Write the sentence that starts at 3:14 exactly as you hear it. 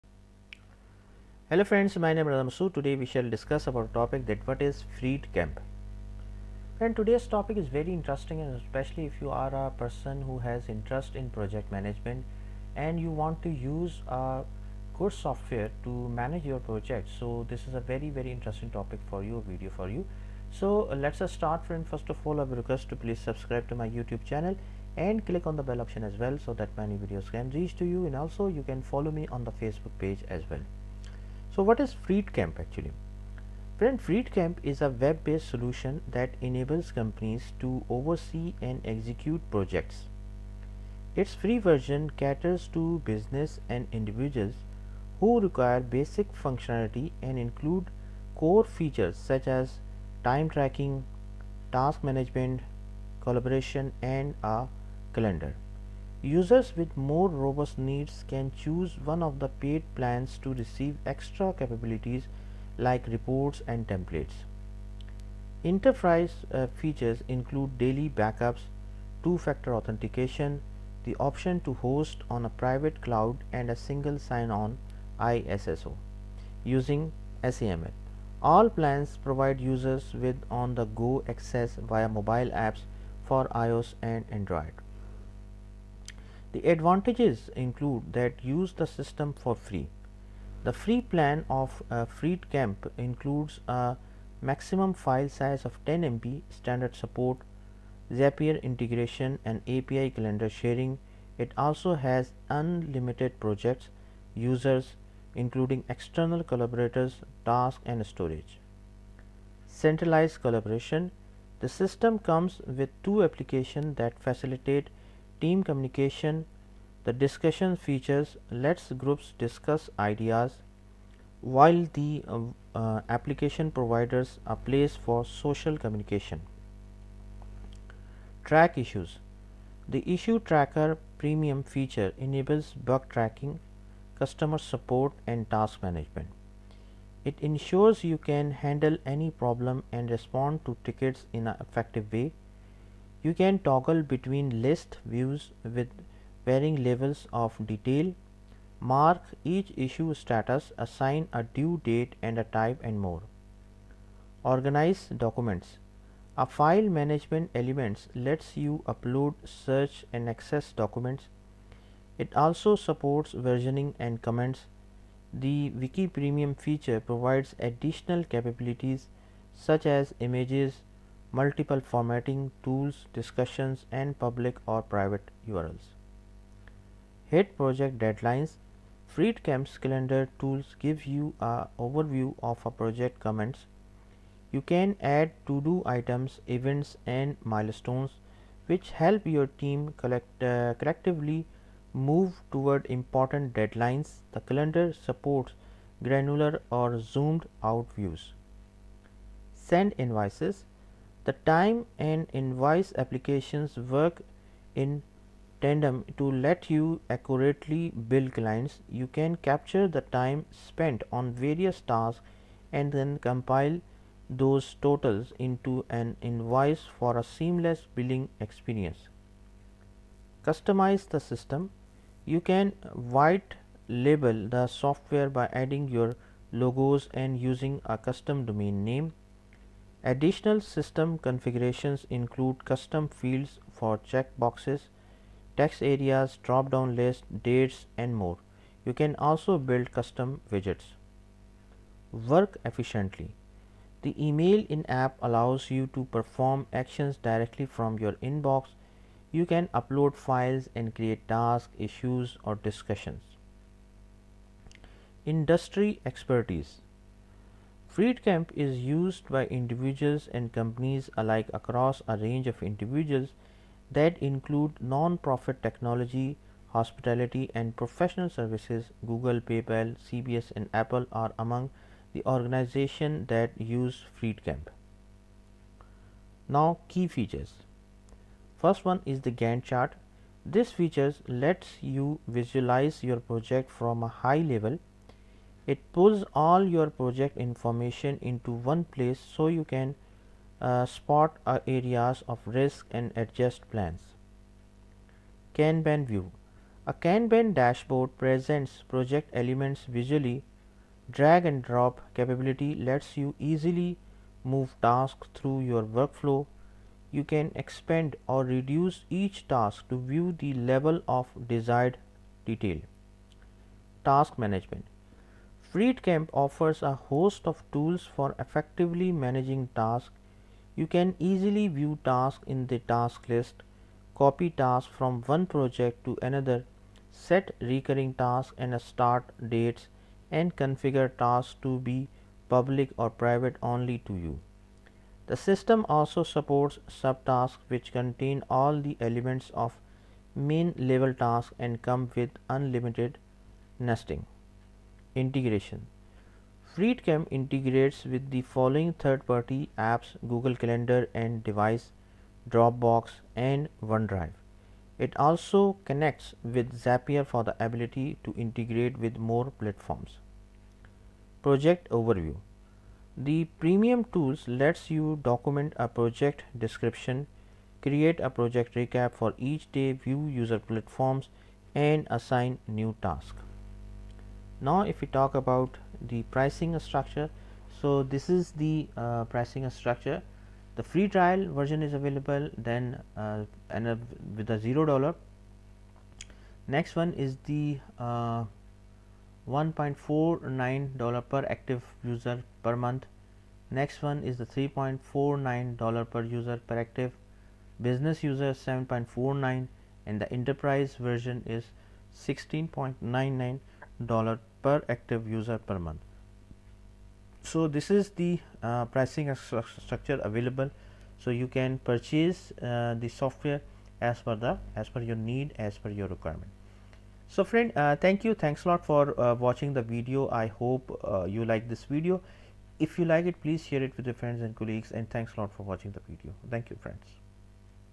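The calendar supports granular or zoomed out views.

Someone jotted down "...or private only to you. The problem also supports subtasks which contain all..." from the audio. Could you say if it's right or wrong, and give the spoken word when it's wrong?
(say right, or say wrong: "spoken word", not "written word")
wrong: "system", not "problem".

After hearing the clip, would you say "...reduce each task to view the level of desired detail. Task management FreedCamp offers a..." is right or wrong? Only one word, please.
right.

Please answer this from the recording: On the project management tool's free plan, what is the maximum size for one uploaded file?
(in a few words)
10 MB.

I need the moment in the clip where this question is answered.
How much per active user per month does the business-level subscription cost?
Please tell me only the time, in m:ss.
6:38.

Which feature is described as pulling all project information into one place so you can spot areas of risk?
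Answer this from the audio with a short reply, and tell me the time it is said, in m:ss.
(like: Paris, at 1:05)
Gantt chart, at 4:39.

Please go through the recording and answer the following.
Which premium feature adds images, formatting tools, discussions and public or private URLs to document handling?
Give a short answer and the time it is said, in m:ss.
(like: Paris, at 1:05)
Wiki, at 2:45.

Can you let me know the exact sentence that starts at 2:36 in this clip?
A file management element lets you upload, search and access documents.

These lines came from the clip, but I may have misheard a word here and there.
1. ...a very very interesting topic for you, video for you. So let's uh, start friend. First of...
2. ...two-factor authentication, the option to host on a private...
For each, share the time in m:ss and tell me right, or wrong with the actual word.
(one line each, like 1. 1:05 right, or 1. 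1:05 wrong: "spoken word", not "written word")
1. 0:17 right
2. 1:09 right.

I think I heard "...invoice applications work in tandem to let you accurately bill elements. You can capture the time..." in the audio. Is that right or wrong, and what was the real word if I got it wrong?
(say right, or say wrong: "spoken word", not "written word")
wrong: "clients", not "elements".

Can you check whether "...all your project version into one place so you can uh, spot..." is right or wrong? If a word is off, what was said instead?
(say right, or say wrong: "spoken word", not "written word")
wrong: "information", not "version".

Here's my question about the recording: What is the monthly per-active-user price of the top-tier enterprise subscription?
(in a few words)
$16.99.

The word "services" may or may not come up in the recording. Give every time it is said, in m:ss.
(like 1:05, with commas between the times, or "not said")
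4:28.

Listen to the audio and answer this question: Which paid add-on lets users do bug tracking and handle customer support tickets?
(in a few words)
issue tracker.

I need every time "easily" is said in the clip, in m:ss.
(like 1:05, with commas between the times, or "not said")
5:03, 5:21.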